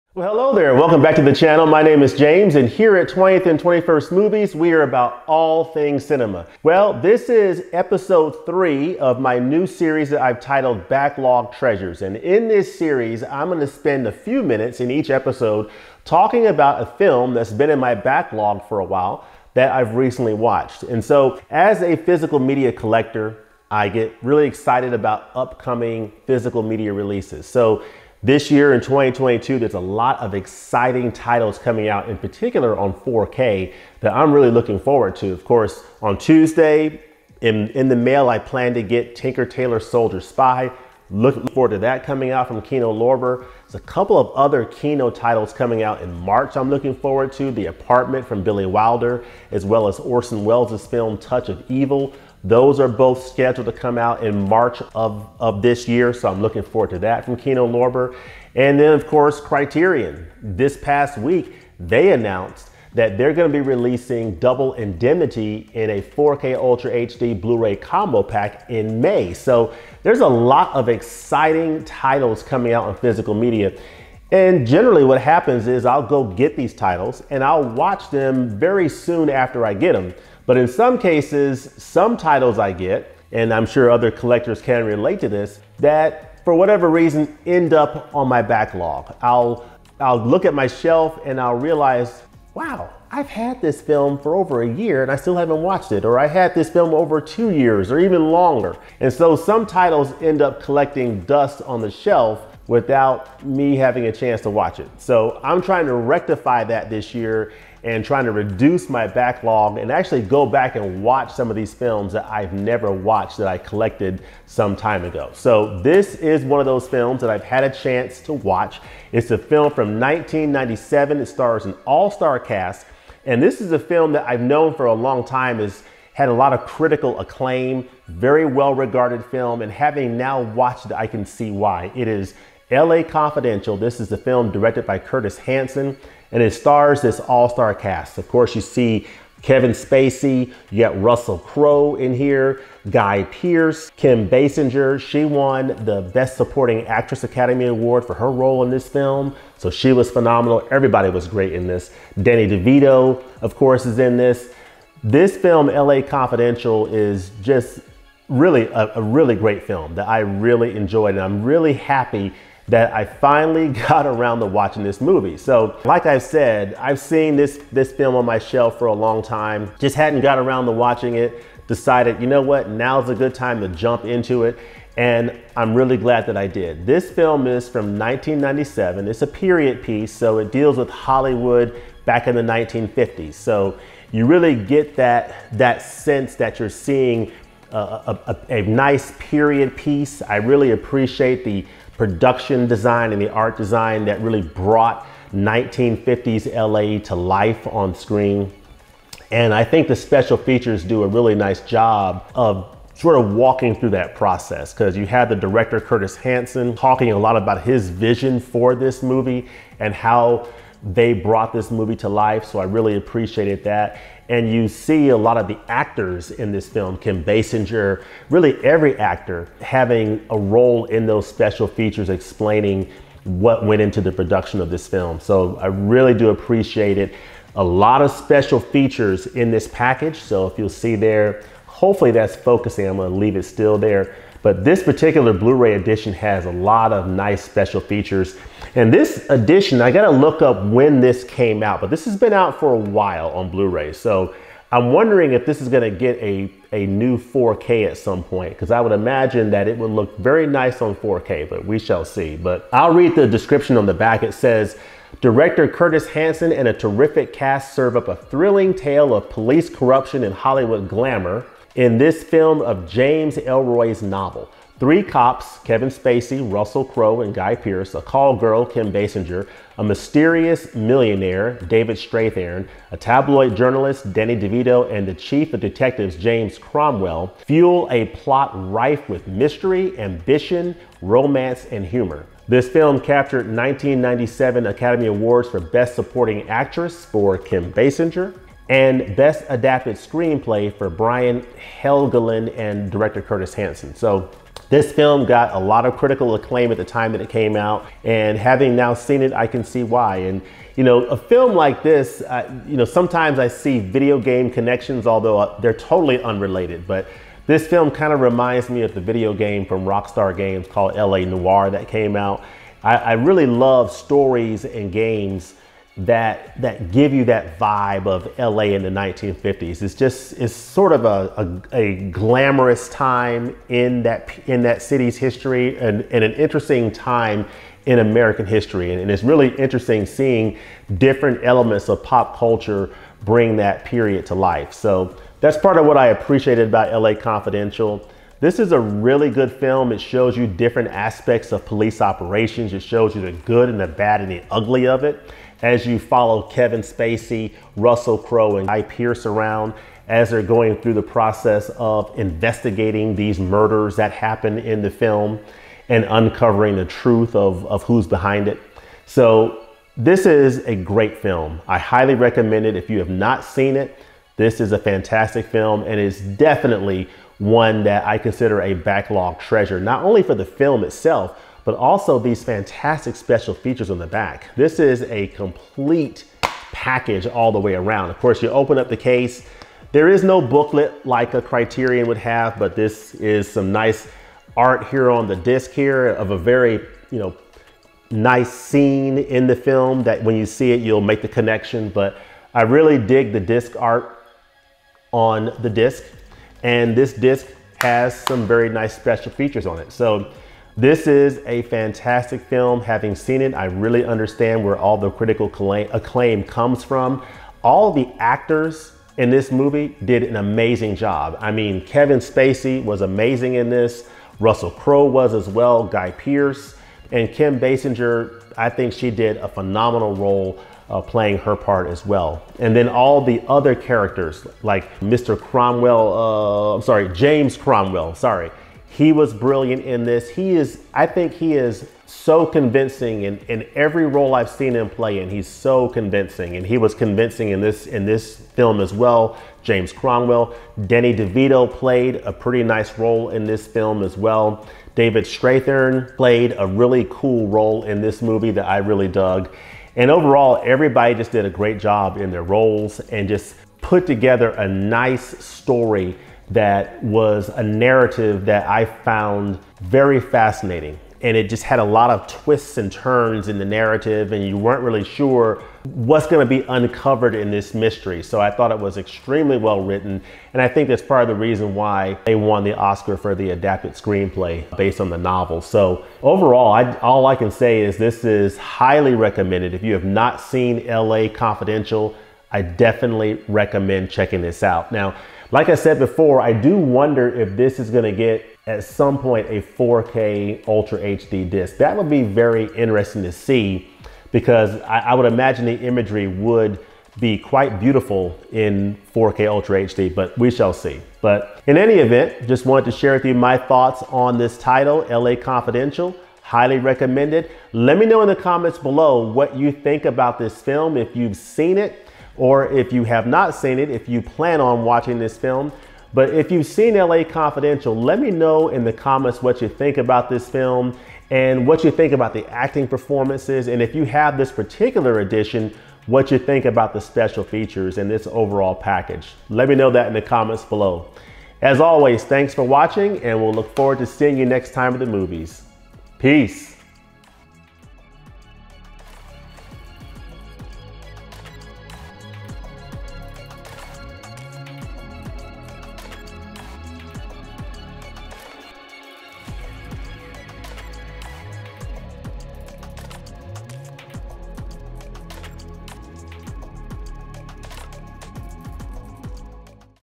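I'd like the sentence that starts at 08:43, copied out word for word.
And if you have this particular edition, what you think about the special features and this overall package.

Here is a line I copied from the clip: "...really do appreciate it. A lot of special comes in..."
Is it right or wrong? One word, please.
wrong.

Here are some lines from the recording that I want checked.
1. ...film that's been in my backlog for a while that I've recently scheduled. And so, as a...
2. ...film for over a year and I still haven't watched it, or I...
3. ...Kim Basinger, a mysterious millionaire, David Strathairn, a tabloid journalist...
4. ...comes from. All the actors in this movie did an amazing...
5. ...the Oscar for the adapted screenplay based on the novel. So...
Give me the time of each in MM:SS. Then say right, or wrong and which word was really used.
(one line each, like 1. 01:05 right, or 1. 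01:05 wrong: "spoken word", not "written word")
1. 00:16 wrong: "watched", not "scheduled"
2. 01:33 right
3. 04:28 right
4. 06:46 right
5. 07:52 right.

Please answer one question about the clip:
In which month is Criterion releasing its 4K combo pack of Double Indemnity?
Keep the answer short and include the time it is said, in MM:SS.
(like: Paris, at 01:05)
May, at 01:08.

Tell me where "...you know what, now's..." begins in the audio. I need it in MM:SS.
02:52.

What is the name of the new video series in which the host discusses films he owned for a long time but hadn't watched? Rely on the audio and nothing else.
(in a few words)
Backlog Treasures.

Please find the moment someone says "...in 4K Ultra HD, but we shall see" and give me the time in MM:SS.
08:18.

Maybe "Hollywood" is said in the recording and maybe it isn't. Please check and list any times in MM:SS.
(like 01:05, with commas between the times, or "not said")
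03:00, 04:20.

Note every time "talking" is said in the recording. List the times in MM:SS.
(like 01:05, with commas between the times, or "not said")
00:16, 03:26.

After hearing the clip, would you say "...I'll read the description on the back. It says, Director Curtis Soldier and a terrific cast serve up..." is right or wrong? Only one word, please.
wrong.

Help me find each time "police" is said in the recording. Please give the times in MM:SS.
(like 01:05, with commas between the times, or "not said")
04:19, 05:41.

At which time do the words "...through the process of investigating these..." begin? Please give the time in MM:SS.
05:50.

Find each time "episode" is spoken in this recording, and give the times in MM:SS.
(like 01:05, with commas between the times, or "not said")
00:07, 00:15.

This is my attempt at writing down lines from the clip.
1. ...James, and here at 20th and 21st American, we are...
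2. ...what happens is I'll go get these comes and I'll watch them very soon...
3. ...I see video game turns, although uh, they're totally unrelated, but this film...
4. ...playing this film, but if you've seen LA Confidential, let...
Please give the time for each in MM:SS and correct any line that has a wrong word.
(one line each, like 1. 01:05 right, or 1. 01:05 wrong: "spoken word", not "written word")
1. 00:02 wrong: "Movies", not "American"
2. 01:15 wrong: "titles", not "comes"
3. 05:03 wrong: "connections", not "turns"
4. 08:34 wrong: "watching", not "playing".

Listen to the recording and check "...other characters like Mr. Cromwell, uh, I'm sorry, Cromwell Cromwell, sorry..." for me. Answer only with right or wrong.
wrong.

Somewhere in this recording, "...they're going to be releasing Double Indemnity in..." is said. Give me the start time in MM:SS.
01:03.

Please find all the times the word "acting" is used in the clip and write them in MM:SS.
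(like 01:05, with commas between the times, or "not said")
08:42.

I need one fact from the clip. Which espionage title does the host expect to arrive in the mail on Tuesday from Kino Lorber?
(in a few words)
Tinker Tailor Soldier Spy.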